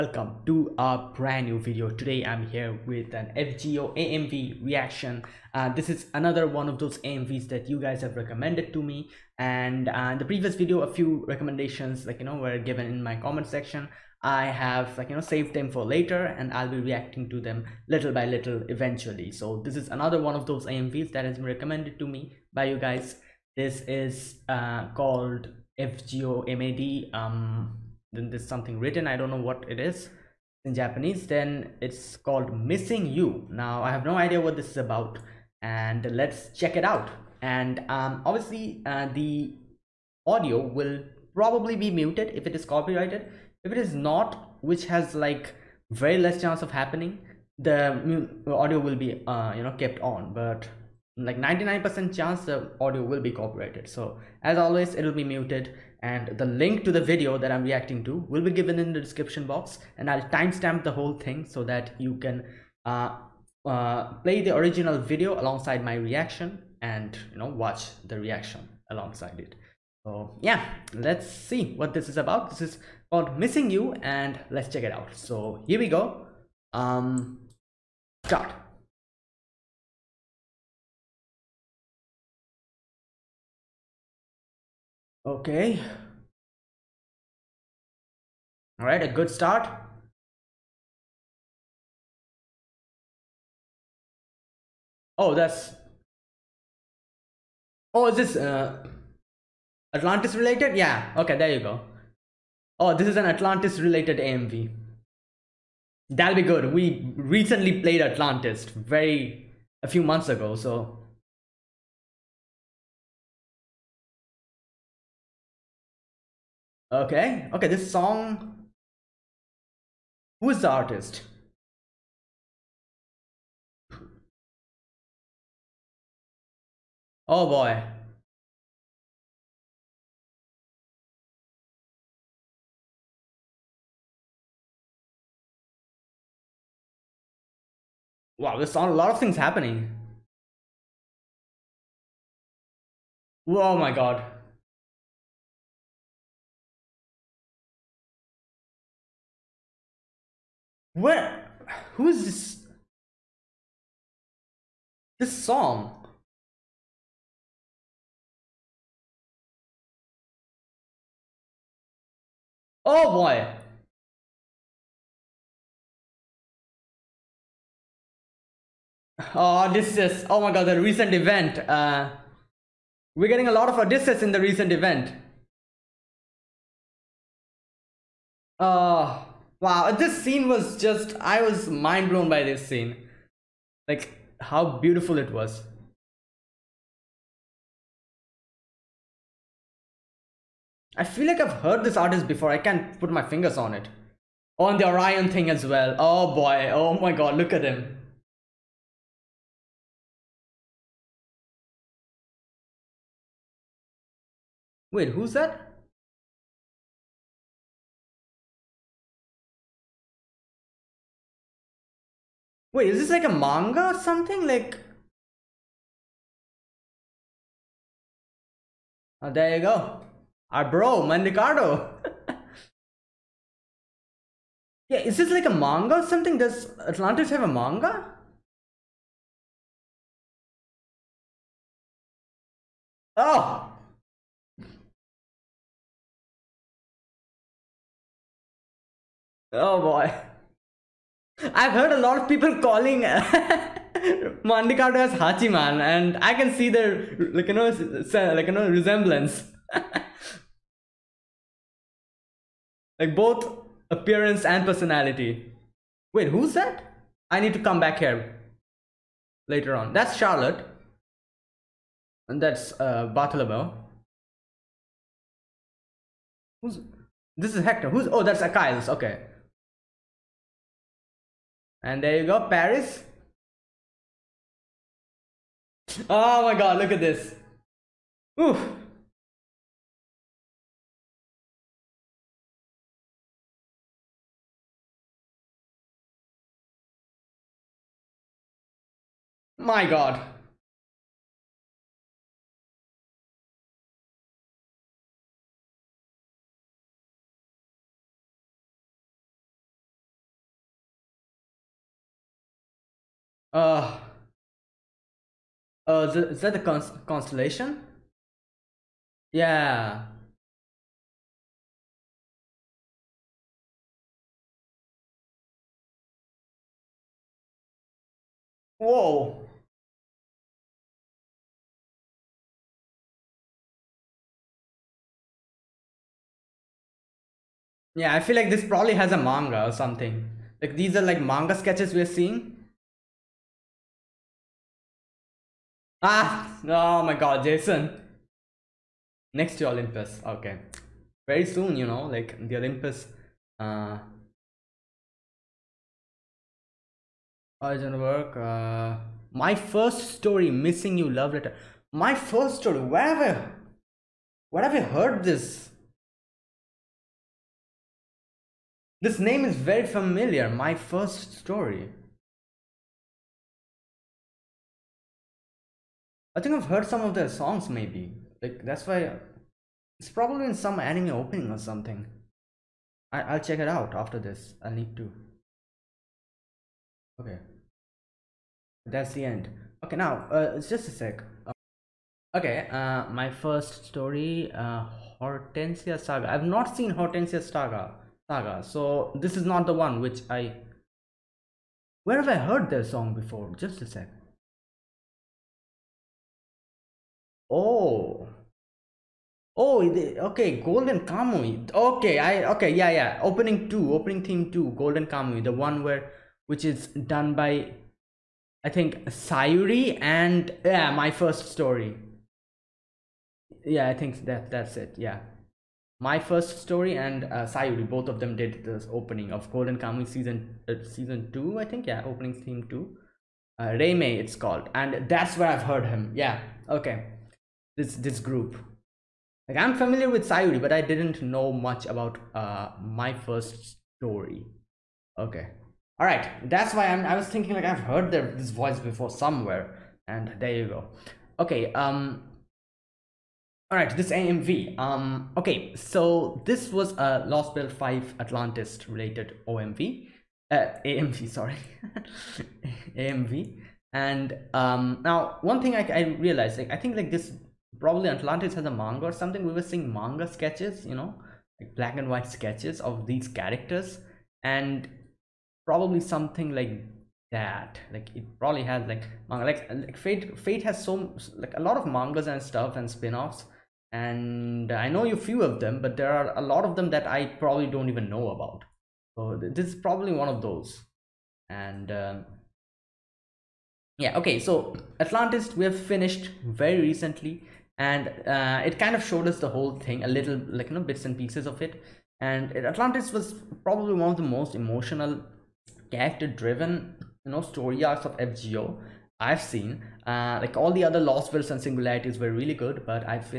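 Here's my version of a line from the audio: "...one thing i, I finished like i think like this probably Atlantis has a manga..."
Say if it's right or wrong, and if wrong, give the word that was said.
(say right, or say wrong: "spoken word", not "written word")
wrong: "realized", not "finished".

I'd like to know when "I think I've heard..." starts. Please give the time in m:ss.
6:06.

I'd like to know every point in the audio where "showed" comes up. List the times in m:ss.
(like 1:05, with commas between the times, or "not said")
8:09.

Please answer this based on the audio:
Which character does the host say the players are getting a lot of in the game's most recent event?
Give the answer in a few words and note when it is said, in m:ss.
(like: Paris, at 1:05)
Odysseus, at 2:53.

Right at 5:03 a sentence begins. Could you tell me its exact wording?
Uh, uh, the, is that the const constellation?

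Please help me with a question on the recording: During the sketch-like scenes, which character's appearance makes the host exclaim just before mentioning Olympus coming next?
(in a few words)
Jason.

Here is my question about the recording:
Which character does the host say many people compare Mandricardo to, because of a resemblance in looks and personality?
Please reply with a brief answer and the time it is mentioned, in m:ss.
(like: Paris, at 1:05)
Hachiman, at 4:05.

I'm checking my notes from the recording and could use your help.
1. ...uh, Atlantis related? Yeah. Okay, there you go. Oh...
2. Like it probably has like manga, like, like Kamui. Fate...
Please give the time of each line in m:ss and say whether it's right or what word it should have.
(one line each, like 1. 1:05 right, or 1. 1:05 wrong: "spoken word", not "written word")
1. 1:38 right
2. 7:47 wrong: "Fate", not "Kamui".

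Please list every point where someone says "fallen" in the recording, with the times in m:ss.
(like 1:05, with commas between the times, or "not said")
not said.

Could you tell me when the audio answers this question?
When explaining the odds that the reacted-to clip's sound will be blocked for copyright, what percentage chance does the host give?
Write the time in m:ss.
0:51.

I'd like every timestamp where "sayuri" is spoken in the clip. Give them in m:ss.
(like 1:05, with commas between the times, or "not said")
6:49, 6:57, 7:10.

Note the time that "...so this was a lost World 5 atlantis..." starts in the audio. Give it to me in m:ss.
7:25.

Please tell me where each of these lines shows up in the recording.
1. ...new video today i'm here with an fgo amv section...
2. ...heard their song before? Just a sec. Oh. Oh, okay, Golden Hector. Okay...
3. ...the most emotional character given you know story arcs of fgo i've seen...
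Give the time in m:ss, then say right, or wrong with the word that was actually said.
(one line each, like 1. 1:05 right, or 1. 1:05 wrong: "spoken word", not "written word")
1. 0:01 wrong: "reaction", not "section"
2. 6:32 wrong: "Kamui", not "Hector"
3. 8:14 wrong: "driven", not "given".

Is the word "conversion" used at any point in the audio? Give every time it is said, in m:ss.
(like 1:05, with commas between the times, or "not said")
not said.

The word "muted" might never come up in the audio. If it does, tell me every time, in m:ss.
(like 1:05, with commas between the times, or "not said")
0:41, 0:55.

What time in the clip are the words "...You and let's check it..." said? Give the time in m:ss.
1:13.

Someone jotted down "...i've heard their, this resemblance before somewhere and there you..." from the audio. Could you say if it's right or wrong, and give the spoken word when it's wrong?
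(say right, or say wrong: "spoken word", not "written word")
wrong: "voice", not "resemblance".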